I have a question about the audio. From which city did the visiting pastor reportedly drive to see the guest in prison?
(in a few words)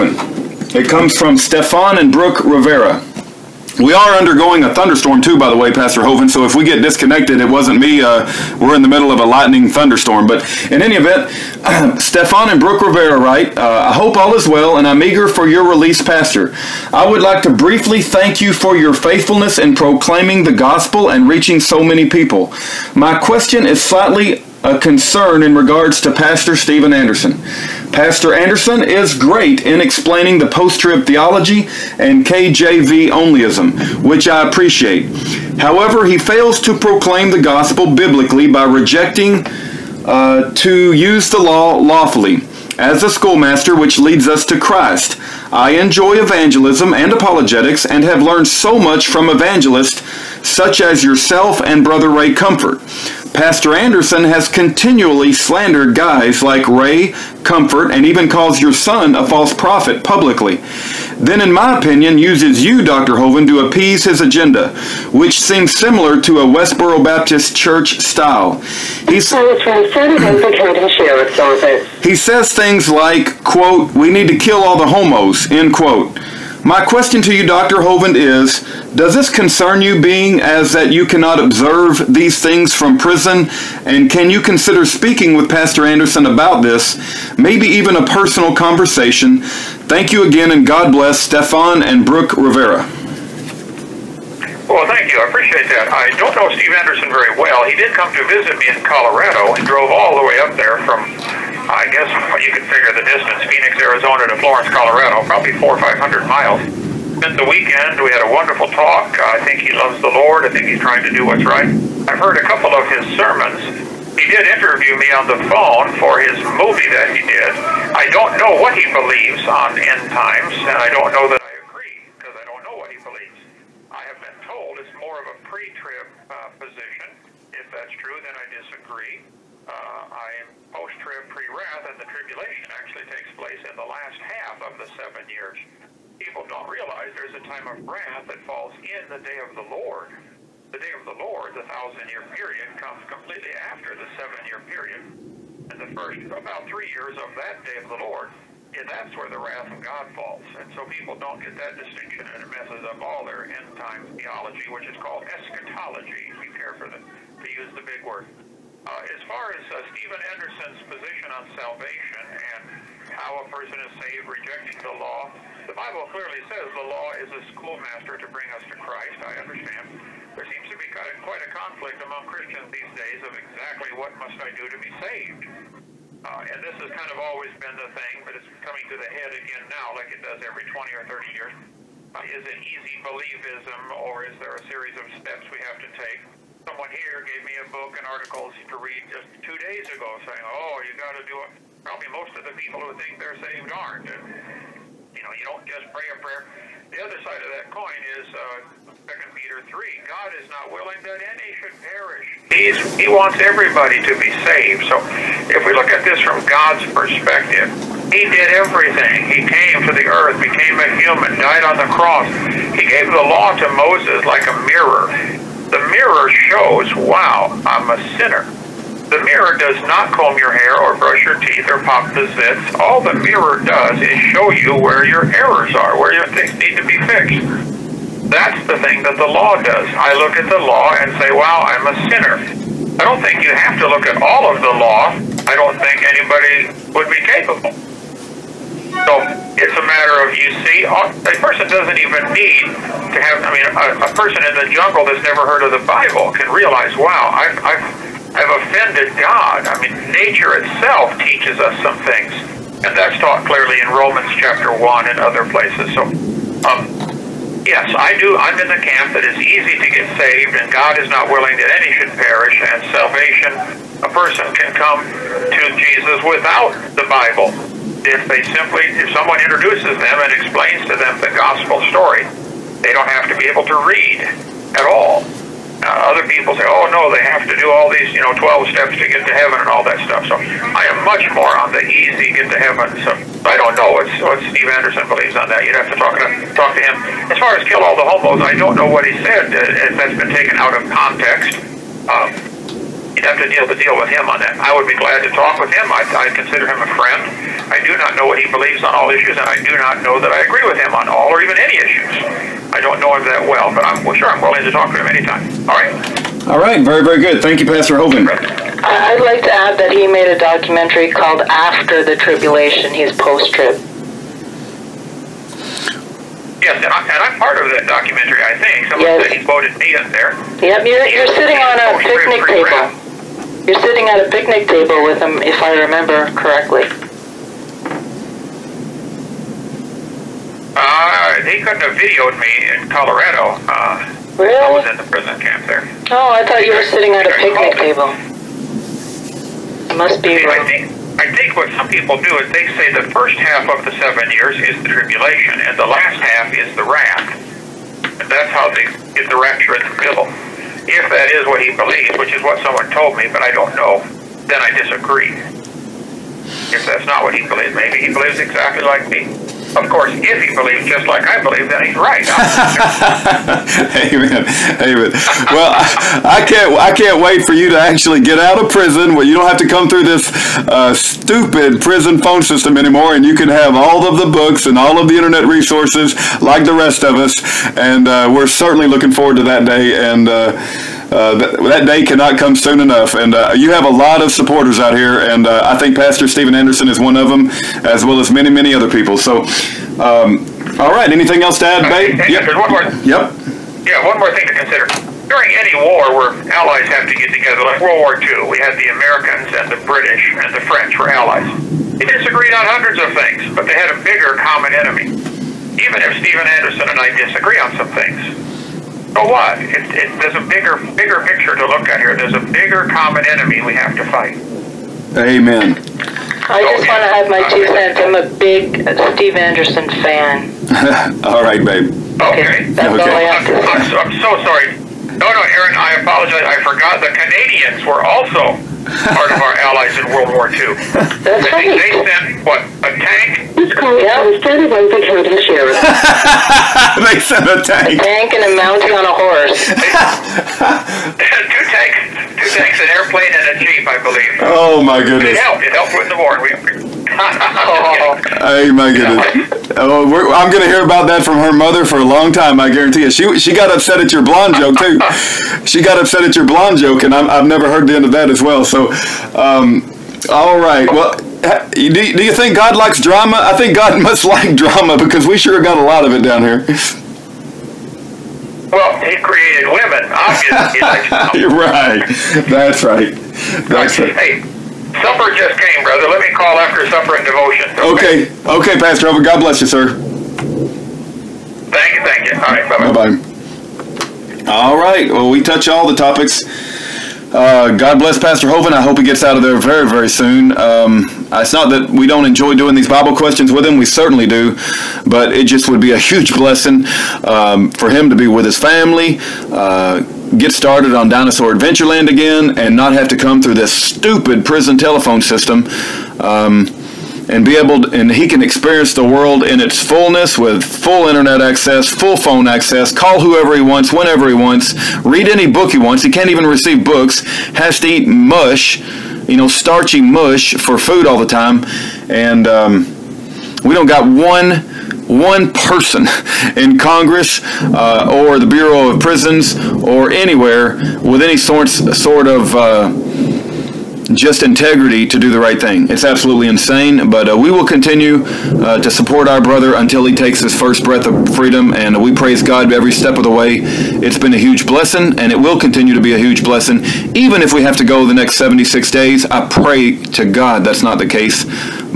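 Phoenix, Arizona.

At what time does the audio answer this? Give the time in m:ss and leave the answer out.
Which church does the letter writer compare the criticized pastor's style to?
1:06.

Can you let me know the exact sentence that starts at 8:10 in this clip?
Um, it's not that we don't enjoy doing these Bible questions with him.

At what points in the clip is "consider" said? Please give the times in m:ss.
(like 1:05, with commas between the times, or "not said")
1:24, 4:56, 6:34.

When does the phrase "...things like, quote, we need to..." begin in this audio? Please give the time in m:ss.
1:12.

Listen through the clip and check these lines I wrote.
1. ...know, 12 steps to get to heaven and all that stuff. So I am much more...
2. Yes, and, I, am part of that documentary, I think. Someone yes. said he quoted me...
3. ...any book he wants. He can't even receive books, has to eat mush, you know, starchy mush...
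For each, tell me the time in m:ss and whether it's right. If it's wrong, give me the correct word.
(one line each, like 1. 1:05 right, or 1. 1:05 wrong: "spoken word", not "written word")
1. 4:38 right
2. 5:16 right
3. 8:35 right.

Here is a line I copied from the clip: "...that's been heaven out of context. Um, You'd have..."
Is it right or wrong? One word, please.
wrong.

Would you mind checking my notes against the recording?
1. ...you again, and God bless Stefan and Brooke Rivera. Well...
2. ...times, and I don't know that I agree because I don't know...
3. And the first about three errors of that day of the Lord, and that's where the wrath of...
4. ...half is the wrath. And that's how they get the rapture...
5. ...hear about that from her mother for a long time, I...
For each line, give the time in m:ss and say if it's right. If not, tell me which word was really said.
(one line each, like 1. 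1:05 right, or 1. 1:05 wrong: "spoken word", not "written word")
1. 1:30 right
2. 2:00 right
3. 2:25 wrong: "years", not "errors"
4. 5:46 right
5. 7:30 right.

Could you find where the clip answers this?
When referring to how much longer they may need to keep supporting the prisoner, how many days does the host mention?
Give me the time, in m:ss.
9:08.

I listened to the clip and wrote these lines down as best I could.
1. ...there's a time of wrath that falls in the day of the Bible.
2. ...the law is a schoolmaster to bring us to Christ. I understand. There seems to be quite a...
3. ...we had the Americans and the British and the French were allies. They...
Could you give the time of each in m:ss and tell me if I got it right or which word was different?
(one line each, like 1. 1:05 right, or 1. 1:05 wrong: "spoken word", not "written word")
1. 2:17 wrong: "Lord", not "Bible"
2. 2:46 right
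3. 6:38 right.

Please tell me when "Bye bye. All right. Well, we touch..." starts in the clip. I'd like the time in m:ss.
8:02.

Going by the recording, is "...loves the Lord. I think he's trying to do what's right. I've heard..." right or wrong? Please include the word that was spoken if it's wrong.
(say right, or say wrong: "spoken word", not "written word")
right.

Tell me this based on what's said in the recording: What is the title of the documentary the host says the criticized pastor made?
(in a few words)
After the Tribulation.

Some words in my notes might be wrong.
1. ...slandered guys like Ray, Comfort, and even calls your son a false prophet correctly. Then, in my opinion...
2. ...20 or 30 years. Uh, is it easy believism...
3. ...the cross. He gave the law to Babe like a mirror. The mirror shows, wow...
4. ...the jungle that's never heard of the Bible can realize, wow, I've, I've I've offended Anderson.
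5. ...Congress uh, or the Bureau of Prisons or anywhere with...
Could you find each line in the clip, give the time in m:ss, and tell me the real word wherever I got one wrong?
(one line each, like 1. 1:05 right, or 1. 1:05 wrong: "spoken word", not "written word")
1. 0:55 wrong: "publicly", not "correctly"
2. 3:00 right
3. 3:31 wrong: "Moses", not "Babe"
4. 4:04 wrong: "God", not "Anderson"
5. 8:46 right.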